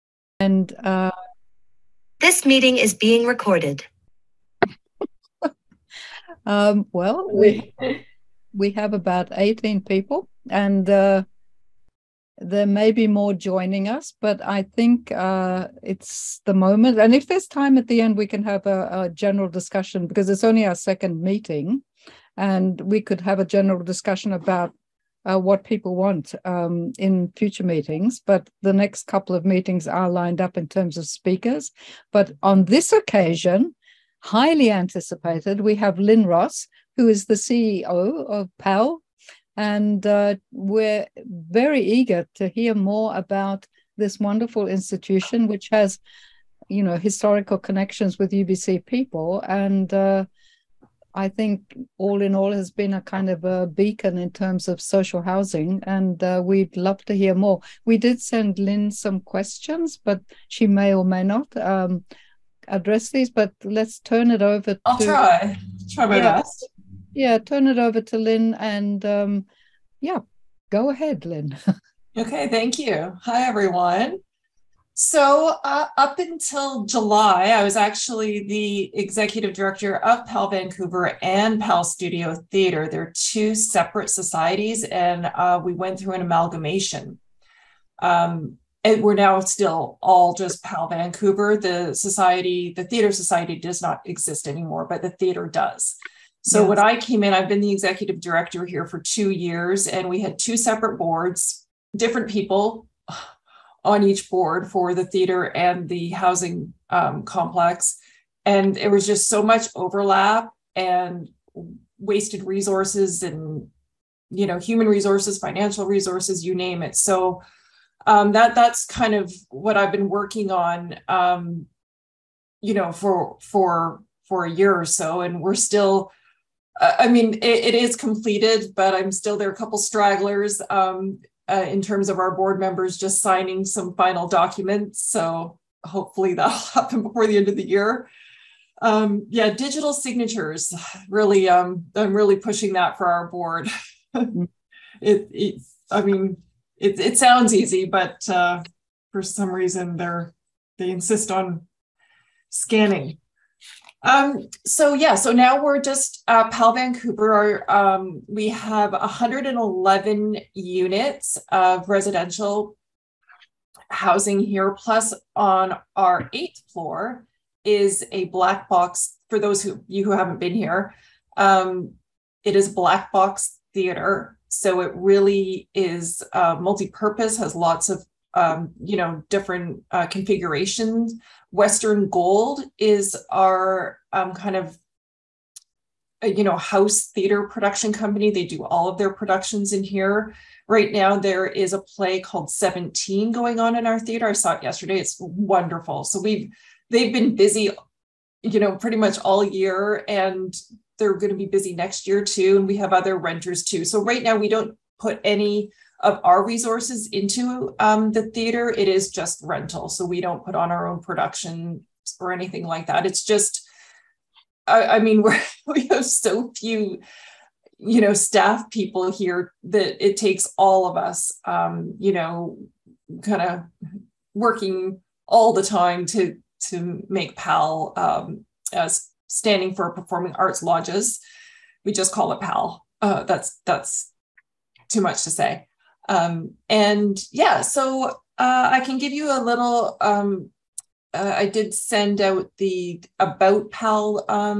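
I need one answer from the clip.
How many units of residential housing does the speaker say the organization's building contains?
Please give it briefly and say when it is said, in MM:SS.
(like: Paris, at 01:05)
111, at 02:38.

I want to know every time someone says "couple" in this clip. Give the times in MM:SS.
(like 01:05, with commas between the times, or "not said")
00:29, 02:09.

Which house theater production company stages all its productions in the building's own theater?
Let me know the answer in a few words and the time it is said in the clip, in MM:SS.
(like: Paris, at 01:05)
Western Gold, at 03:01.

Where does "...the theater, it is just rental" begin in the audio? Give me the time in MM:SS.
03:28.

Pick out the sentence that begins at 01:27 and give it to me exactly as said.
Um, and we're now still all just PAL Vancouver.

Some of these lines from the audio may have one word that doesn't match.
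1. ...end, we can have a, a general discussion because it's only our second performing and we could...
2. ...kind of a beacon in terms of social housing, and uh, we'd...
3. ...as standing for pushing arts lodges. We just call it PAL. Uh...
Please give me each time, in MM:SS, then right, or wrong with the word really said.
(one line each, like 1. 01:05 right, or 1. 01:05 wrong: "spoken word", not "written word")
1. 00:17 wrong: "meeting", not "performing"
2. 00:52 right
3. 03:48 wrong: "performing", not "pushing".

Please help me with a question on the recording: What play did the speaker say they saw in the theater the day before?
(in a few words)
17.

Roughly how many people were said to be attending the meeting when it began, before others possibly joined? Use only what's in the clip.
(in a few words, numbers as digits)
18.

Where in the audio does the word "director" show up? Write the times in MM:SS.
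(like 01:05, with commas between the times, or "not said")
01:19, 01:38.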